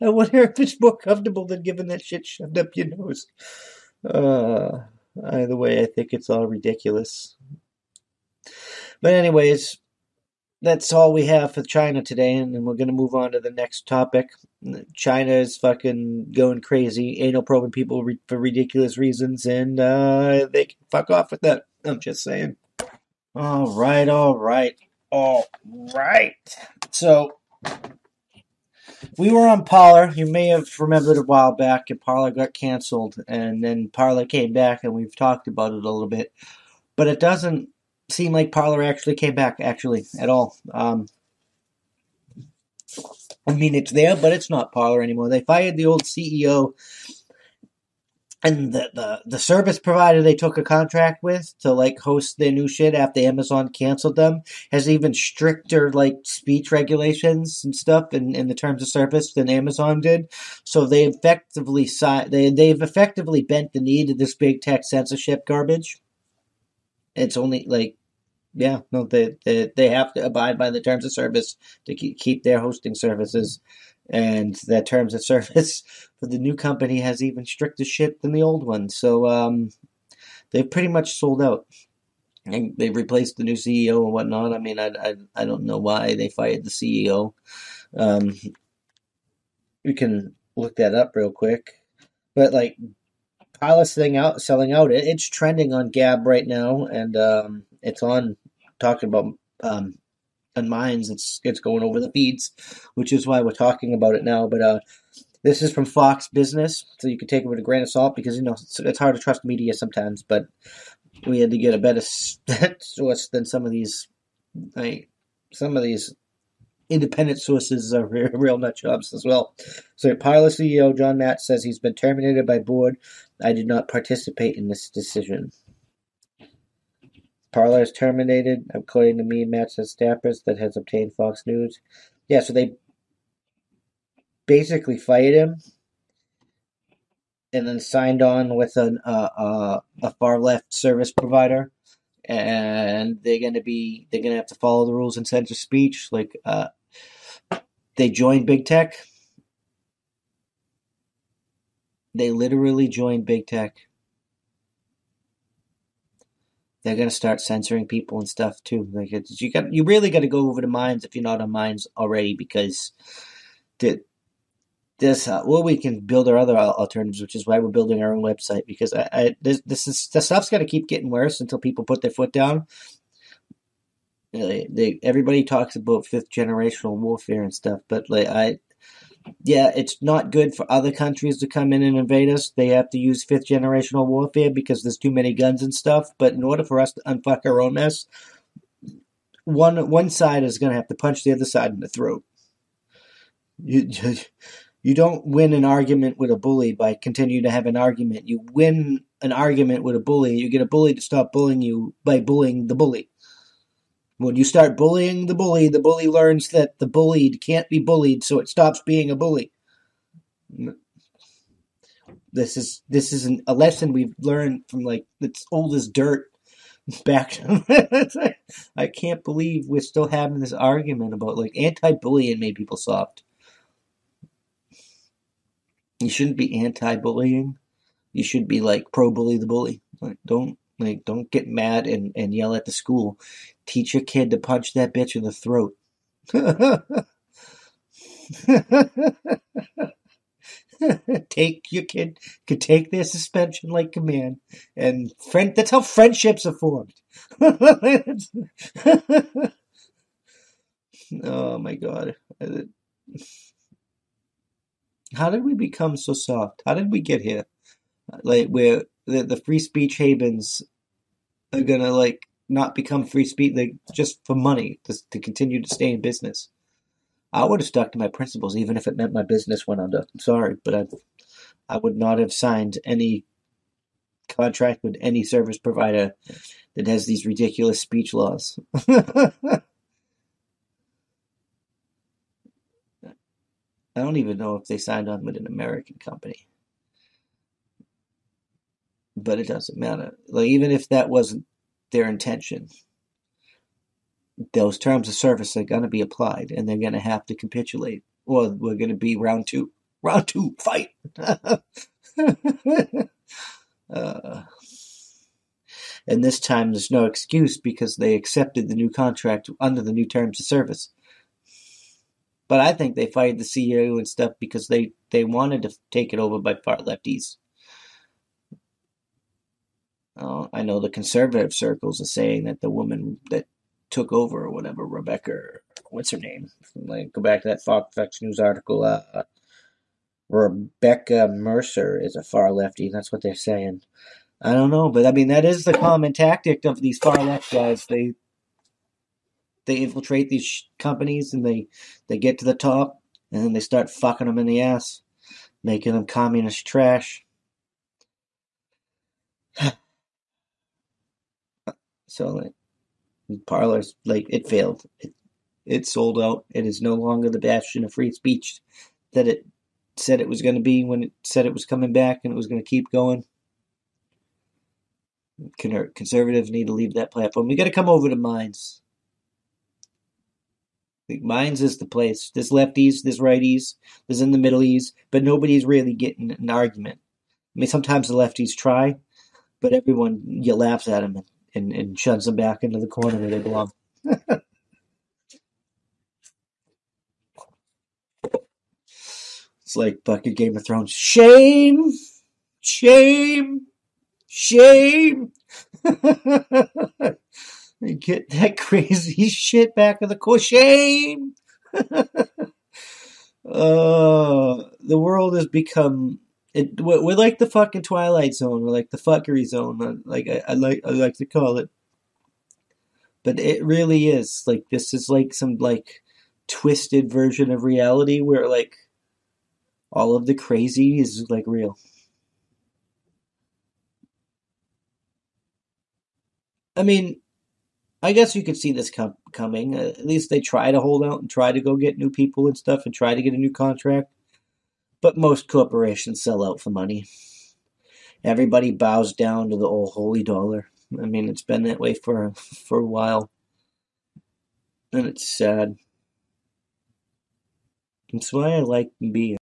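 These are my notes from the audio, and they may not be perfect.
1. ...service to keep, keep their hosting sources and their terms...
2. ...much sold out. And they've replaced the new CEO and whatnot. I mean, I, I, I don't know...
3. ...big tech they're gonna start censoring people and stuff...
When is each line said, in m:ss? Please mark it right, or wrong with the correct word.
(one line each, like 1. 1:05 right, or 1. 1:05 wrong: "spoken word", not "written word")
1. 1:11 wrong: "services", not "sources"
2. 1:20 right
3. 2:33 right.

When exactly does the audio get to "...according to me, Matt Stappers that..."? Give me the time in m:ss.
2:08.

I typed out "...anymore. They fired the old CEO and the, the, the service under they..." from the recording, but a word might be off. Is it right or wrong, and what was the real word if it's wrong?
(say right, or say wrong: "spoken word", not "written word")
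wrong: "provider", not "under".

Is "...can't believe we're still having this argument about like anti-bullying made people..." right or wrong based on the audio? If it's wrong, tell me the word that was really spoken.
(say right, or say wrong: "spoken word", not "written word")
right.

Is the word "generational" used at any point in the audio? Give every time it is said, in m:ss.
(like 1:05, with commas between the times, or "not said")
2:56, 3:03.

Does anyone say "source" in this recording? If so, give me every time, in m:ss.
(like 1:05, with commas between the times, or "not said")
1:52, 1:57.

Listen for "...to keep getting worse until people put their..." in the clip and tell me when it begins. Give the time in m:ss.
2:50.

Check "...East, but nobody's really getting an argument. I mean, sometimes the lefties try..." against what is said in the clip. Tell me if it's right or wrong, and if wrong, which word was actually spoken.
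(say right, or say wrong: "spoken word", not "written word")
right.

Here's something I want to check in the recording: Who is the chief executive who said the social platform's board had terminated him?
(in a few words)
John Matt.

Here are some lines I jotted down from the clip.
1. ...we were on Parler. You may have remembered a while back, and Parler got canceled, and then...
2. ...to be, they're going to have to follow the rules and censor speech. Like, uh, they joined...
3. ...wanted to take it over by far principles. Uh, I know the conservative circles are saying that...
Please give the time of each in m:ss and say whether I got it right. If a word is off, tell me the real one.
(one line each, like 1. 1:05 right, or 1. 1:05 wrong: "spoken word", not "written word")
1. 0:29 right
2. 2:23 right
3. 5:15 wrong: "lefties", not "principles".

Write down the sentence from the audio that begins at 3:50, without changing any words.
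Like don't like, don't get mad and, and yell at the school.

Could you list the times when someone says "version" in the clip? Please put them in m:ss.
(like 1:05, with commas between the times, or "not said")
6:57.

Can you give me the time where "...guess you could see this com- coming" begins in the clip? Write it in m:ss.
7:08.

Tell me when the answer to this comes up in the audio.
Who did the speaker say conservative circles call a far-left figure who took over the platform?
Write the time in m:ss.
5:30.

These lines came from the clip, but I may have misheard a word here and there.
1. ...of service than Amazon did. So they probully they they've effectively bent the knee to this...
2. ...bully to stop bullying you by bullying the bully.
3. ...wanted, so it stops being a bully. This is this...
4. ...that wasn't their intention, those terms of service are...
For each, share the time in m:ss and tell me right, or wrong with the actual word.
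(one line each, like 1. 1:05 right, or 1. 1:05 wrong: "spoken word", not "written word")
1. 0:58 wrong: "effectively", not "probully"
2. 3:20 right
3. 3:27 wrong: "bullied", not "wanted"
4. 4:50 right.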